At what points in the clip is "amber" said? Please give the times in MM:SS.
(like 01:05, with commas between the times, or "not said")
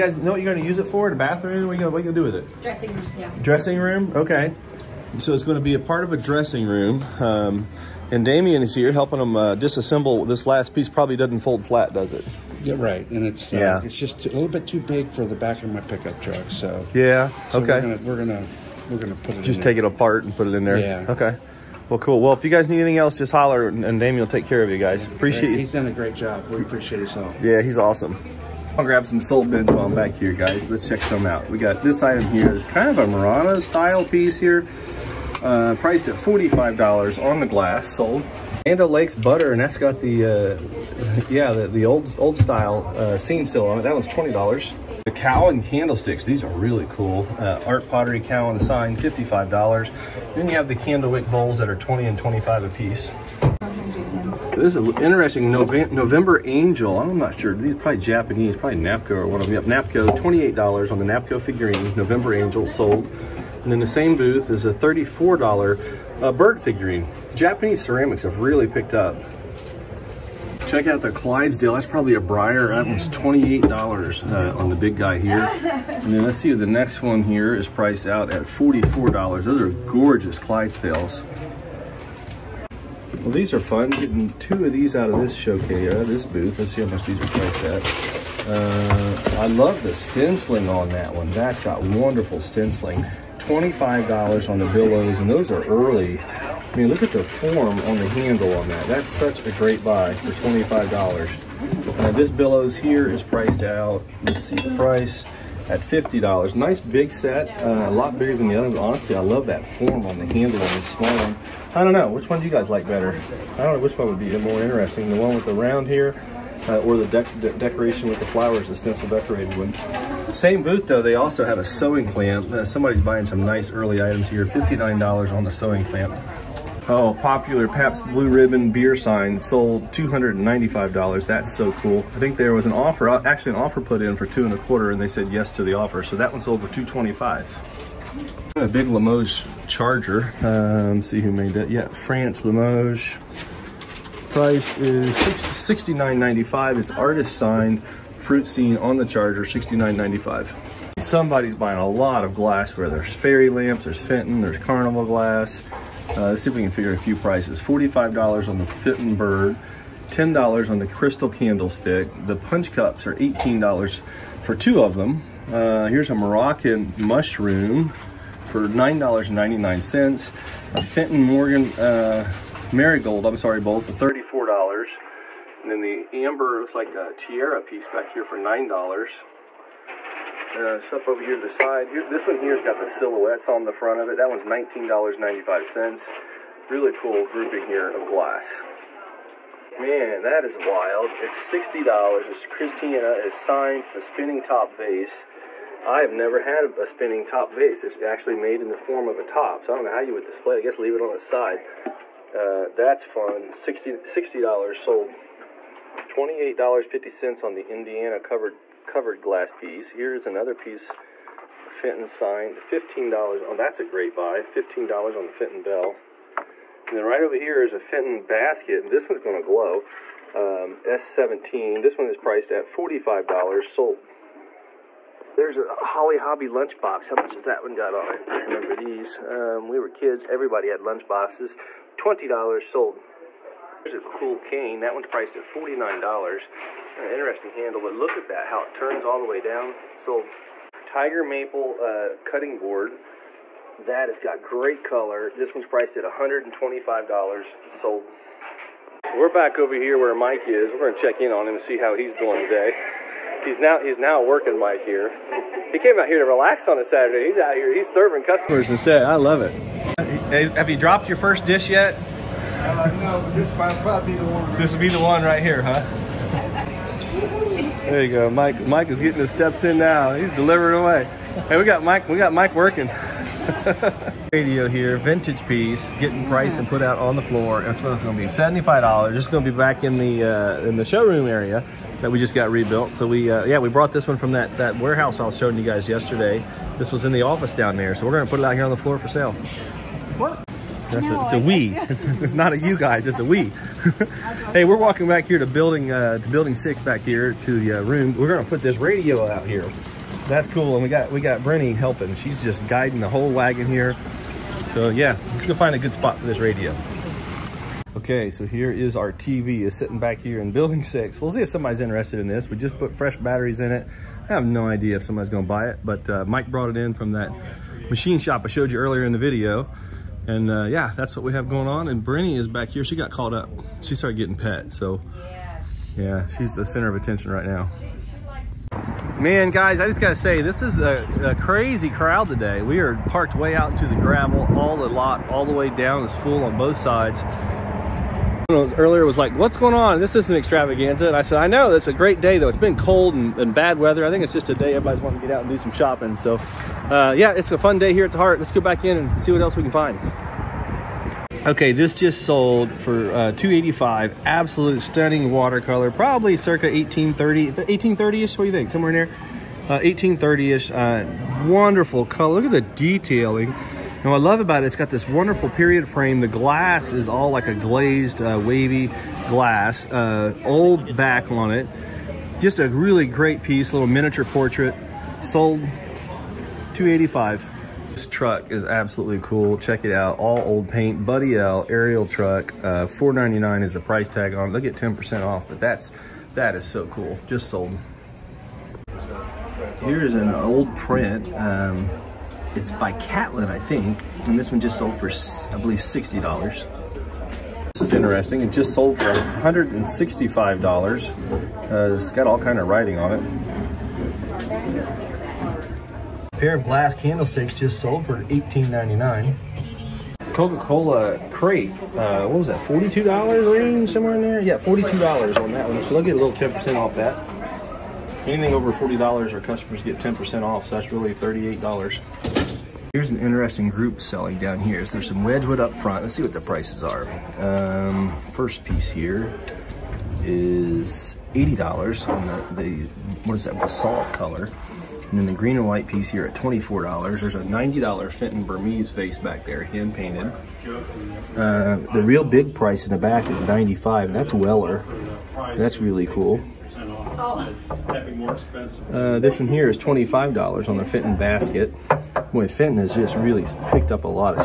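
02:56.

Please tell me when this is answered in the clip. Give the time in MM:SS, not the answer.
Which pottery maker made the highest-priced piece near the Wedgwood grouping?
07:24.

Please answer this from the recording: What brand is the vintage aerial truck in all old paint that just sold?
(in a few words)
Buddy L.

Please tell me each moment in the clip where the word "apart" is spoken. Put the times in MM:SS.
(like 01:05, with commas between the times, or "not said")
00:19.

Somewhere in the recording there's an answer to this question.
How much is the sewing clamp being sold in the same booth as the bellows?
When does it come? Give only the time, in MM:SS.
02:04.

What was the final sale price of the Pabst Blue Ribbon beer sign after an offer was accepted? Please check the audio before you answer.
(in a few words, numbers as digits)
$225.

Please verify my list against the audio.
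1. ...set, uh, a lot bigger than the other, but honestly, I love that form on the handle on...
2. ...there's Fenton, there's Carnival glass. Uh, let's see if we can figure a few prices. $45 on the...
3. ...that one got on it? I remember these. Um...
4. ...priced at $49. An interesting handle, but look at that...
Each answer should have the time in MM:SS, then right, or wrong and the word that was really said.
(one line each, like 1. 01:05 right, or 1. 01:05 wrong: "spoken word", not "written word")
1. 01:47 right
2. 02:33 right
3. 03:47 right
4. 03:55 right.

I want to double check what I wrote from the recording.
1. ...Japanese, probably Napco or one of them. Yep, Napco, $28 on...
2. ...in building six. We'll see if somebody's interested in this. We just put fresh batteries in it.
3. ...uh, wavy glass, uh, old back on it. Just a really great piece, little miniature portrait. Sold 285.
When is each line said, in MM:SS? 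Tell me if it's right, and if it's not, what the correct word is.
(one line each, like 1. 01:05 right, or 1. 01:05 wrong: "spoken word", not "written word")
1. 00:58 right
2. 05:10 right
3. 06:08 right.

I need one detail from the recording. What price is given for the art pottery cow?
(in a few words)
$55.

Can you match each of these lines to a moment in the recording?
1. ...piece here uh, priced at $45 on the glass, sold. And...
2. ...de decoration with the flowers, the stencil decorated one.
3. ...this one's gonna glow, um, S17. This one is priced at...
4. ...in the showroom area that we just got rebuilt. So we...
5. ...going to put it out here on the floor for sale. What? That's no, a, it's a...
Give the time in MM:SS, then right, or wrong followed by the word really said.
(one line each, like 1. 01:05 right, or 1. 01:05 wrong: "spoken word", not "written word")
1. 00:34 right
2. 01:57 right
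3. 03:38 right
4. 04:40 right
5. 04:48 right.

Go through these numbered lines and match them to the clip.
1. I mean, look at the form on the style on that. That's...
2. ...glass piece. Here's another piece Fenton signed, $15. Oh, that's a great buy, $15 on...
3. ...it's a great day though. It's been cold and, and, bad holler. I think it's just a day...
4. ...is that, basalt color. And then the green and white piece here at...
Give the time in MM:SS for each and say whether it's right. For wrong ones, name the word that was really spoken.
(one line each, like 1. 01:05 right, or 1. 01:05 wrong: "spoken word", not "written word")
1. 01:36 wrong: "handle", not "style"
2. 03:29 right
3. 05:41 wrong: "weather", not "holler"
4. 07:13 right.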